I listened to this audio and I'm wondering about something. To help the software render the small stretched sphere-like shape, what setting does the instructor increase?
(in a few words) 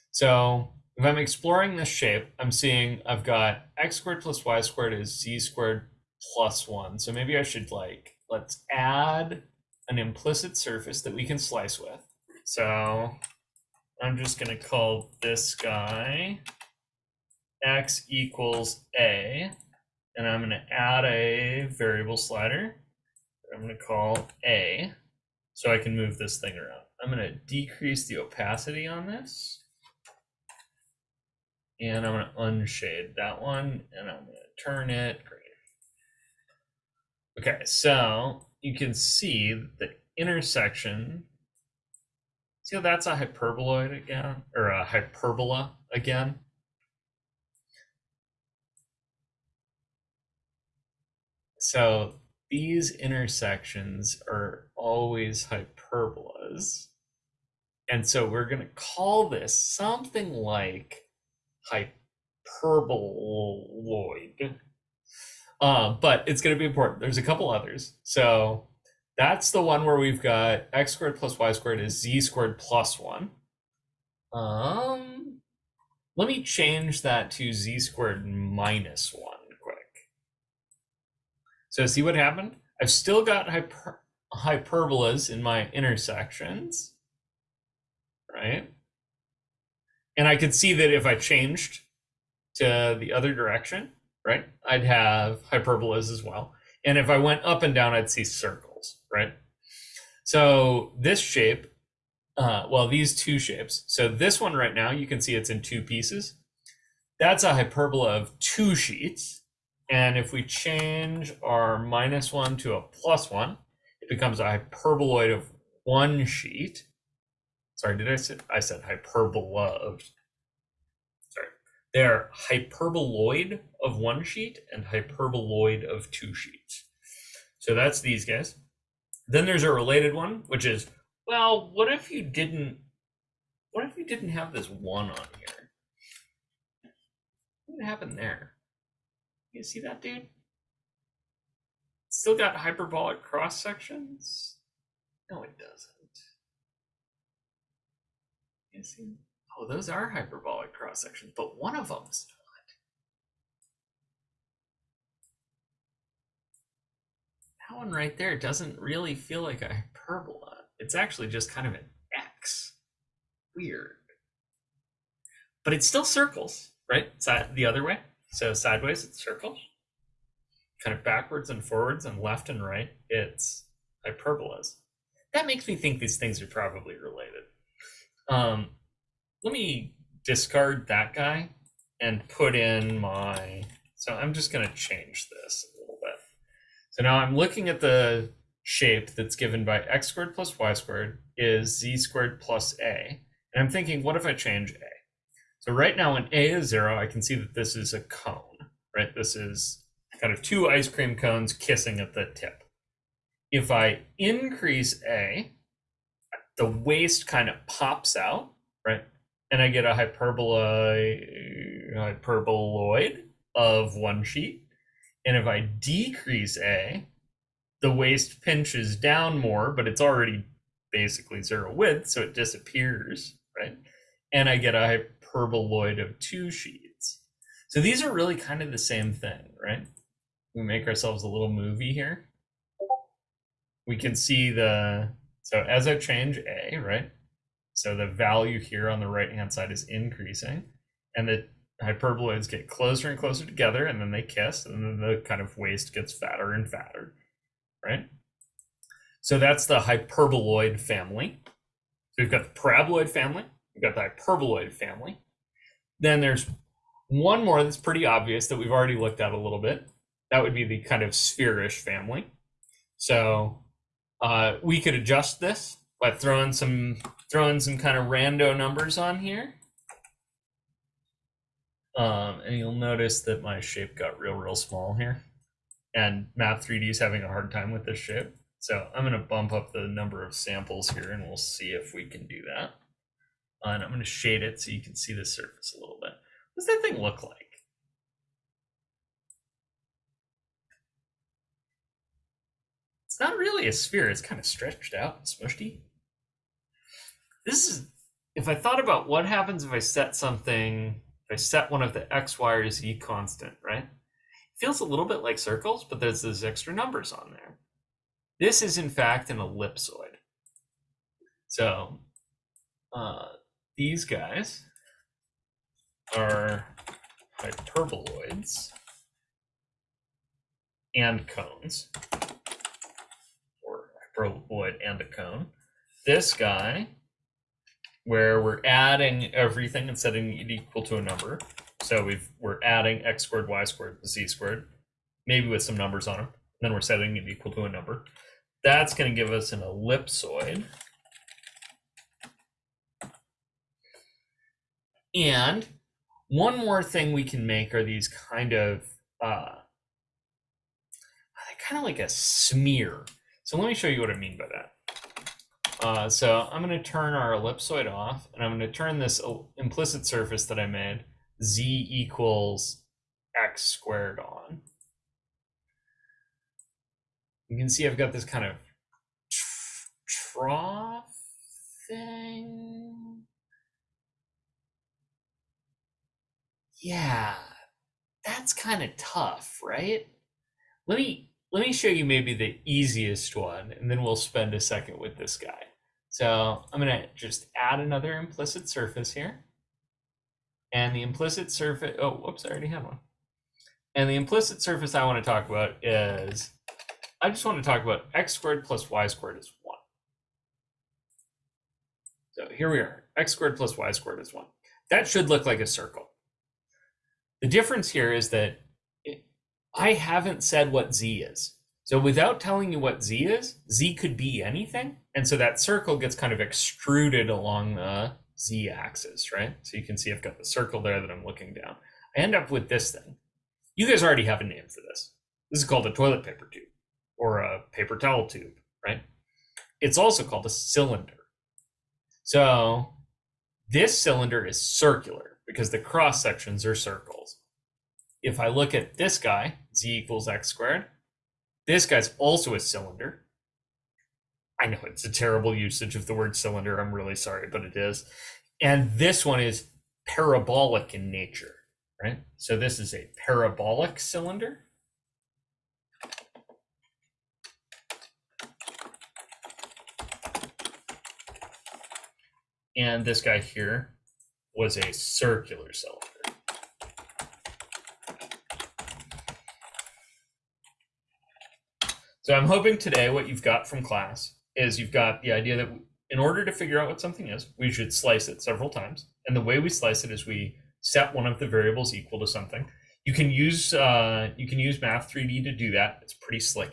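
number of samples.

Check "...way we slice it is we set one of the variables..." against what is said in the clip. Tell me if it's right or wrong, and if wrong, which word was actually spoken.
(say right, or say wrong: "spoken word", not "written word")
right.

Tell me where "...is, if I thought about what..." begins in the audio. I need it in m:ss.
4:57.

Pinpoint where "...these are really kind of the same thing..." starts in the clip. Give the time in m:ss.
3:47.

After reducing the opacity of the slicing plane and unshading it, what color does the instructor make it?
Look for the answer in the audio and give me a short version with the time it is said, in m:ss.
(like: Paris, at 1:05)
green, at 0:34.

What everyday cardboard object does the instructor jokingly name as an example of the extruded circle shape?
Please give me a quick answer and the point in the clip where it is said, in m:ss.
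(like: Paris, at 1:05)
toilet paper tube, at 7:05.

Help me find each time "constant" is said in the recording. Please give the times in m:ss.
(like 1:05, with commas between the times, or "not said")
5:02.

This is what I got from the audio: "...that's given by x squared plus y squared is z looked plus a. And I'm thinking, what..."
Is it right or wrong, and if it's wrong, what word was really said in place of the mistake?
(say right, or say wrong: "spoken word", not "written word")
wrong: "squared", not "looked".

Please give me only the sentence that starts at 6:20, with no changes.
Let me let me show you maybe the easiest one, and then we'll spend a second with this guy.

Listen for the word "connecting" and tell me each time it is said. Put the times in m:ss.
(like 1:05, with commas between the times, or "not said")
not said.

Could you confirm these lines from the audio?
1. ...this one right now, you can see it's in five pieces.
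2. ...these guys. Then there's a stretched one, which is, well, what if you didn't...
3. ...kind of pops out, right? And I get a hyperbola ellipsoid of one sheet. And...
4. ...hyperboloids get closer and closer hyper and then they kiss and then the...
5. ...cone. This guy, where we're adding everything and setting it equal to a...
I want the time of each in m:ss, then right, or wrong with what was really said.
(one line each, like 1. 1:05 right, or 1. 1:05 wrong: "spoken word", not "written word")
1. 1:44 wrong: "two", not "five"
2. 2:08 wrong: "related", not "stretched"
3. 3:27 wrong: "hyperboloid", not "ellipsoid"
4. 4:01 wrong: "together", not "hyper"
5. 5:25 right.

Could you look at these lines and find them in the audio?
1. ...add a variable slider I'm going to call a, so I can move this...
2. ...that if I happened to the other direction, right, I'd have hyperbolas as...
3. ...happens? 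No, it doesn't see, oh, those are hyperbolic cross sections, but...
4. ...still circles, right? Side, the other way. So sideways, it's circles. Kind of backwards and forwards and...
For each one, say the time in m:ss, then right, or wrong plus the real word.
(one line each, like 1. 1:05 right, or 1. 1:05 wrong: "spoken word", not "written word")
1. 0:20 right
2. 1:30 wrong: "changed", not "happened"
3. 2:23 wrong: "sections", not "happens"
4. 2:45 right.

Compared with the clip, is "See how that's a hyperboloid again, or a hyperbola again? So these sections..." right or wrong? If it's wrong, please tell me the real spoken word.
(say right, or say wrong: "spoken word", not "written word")
wrong: "intersections", not "sections".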